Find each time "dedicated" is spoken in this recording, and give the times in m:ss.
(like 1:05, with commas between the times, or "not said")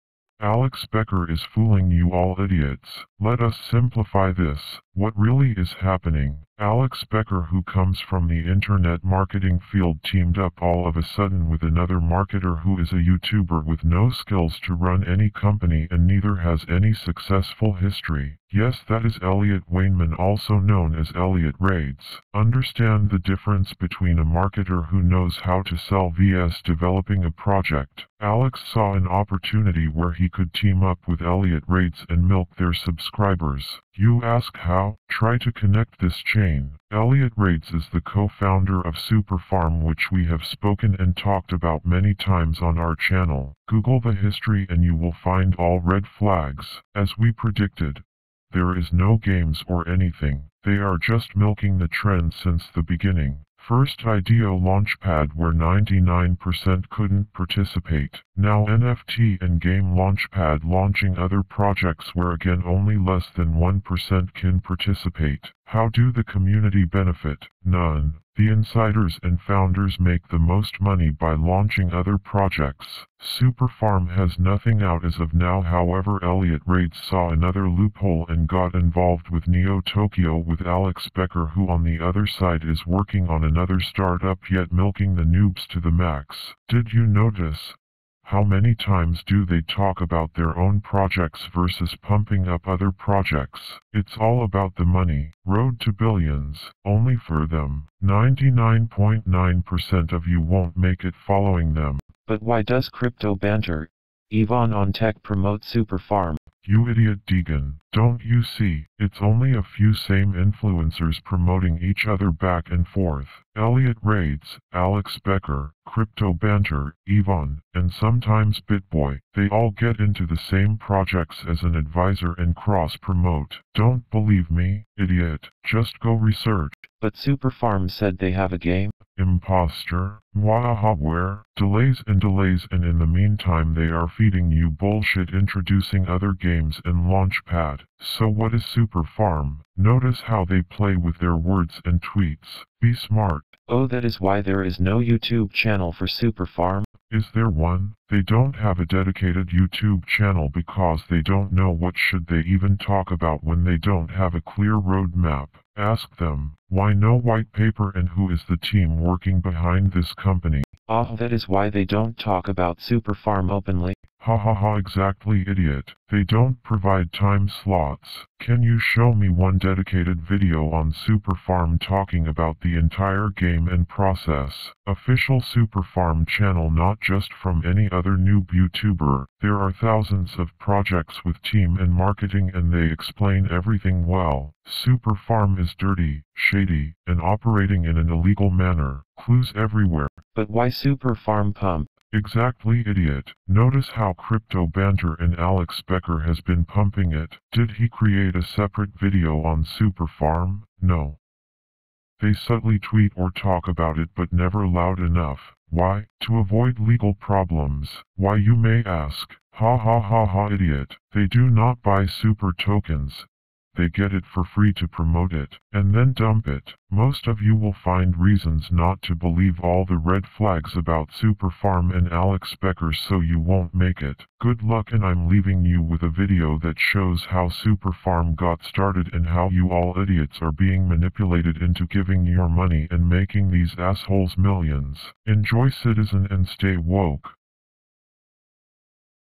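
2:28, 2:49.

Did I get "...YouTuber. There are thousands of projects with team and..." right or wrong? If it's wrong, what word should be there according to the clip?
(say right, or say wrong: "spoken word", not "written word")
right.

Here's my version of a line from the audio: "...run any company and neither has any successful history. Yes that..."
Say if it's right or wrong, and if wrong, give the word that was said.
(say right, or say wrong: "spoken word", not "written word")
right.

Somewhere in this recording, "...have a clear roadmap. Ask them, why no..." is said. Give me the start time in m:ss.
2:34.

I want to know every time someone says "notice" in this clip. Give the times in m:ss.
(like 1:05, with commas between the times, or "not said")
1:27, 2:19, 3:13.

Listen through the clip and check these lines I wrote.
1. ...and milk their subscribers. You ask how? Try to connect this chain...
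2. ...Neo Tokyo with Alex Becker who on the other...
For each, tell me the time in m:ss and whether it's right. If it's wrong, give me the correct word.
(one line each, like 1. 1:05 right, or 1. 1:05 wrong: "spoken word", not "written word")
1. 0:32 right
2. 1:19 right.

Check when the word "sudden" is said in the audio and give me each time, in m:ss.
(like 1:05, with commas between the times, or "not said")
0:11.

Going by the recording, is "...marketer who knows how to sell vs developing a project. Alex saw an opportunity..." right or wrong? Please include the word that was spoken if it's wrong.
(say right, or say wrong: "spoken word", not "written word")
right.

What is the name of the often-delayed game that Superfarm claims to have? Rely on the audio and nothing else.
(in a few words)
Imposter.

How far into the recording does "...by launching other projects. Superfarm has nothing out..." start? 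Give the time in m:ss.
1:11.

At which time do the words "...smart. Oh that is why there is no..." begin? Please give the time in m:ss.
2:22.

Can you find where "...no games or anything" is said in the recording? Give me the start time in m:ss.
0:48.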